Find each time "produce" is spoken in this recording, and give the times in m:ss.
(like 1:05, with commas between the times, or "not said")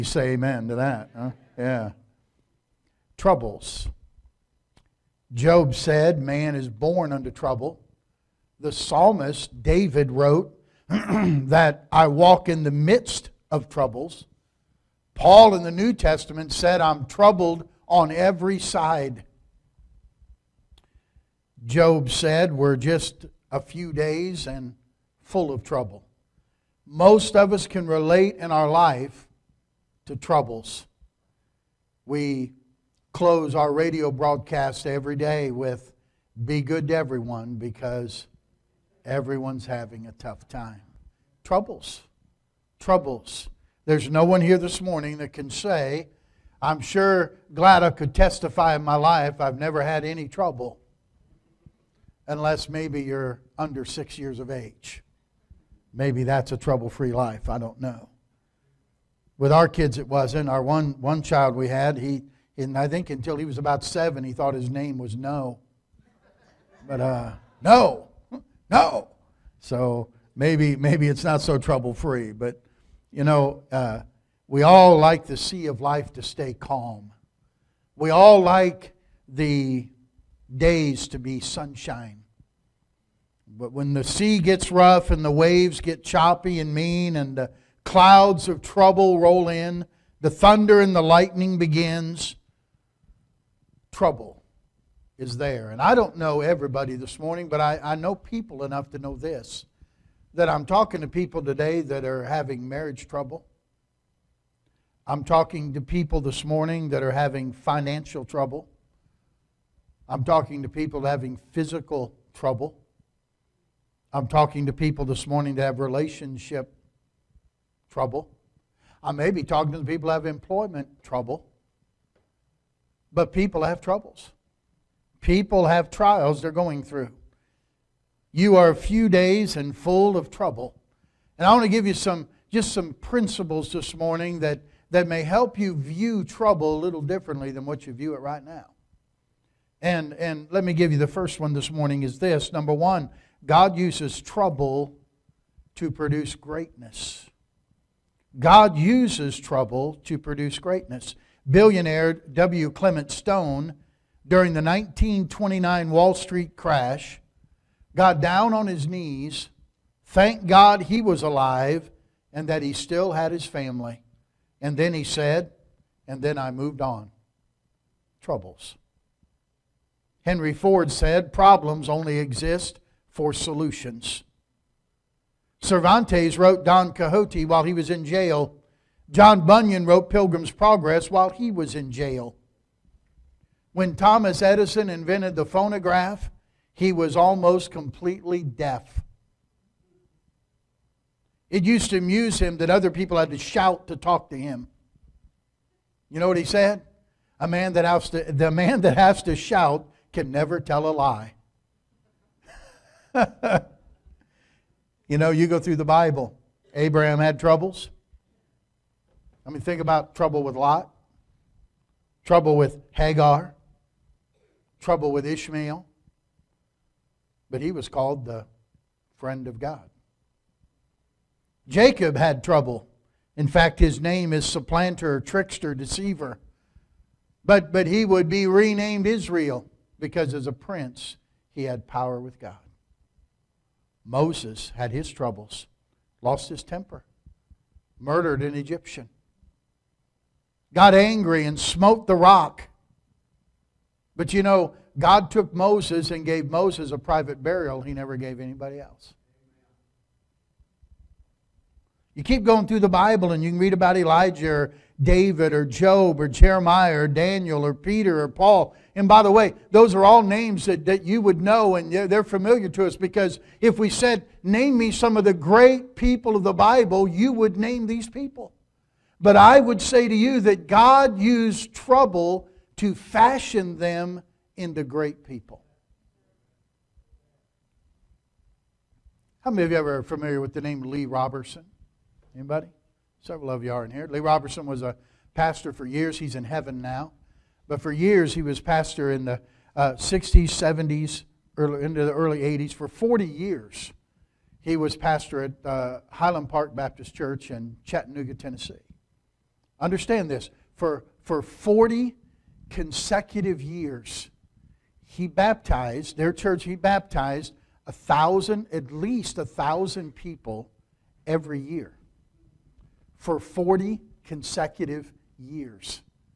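2:25, 2:30.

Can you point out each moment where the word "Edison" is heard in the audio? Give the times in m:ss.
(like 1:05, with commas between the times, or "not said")
3:04.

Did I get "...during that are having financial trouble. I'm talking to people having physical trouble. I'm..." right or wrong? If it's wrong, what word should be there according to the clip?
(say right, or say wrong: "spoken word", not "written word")
wrong: "morning", not "during".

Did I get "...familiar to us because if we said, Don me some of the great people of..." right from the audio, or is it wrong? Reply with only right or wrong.
wrong.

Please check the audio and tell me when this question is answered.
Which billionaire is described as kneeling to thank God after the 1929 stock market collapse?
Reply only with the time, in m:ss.
2:32.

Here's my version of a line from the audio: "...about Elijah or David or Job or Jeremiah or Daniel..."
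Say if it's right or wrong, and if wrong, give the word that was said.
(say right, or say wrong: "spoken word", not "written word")
right.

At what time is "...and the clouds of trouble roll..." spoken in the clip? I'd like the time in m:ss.
1:27.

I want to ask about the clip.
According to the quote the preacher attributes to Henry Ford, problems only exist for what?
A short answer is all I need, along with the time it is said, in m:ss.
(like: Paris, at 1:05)
Solutions, at 2:53.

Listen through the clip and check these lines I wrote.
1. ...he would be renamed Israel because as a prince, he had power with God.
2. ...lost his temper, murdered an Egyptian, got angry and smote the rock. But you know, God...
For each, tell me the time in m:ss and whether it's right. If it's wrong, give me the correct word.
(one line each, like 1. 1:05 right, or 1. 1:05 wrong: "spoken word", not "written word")
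1. 3:47 right
2. 3:56 right.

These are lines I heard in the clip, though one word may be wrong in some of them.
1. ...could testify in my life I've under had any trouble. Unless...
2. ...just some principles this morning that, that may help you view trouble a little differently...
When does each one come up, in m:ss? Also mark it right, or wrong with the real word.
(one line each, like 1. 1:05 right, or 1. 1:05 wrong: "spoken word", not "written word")
1. 0:47 wrong: "never", not "under"
2. 2:12 right.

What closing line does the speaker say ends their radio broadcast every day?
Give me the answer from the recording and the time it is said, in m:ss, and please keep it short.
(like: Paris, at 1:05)
Be good to everyone, at 0:36.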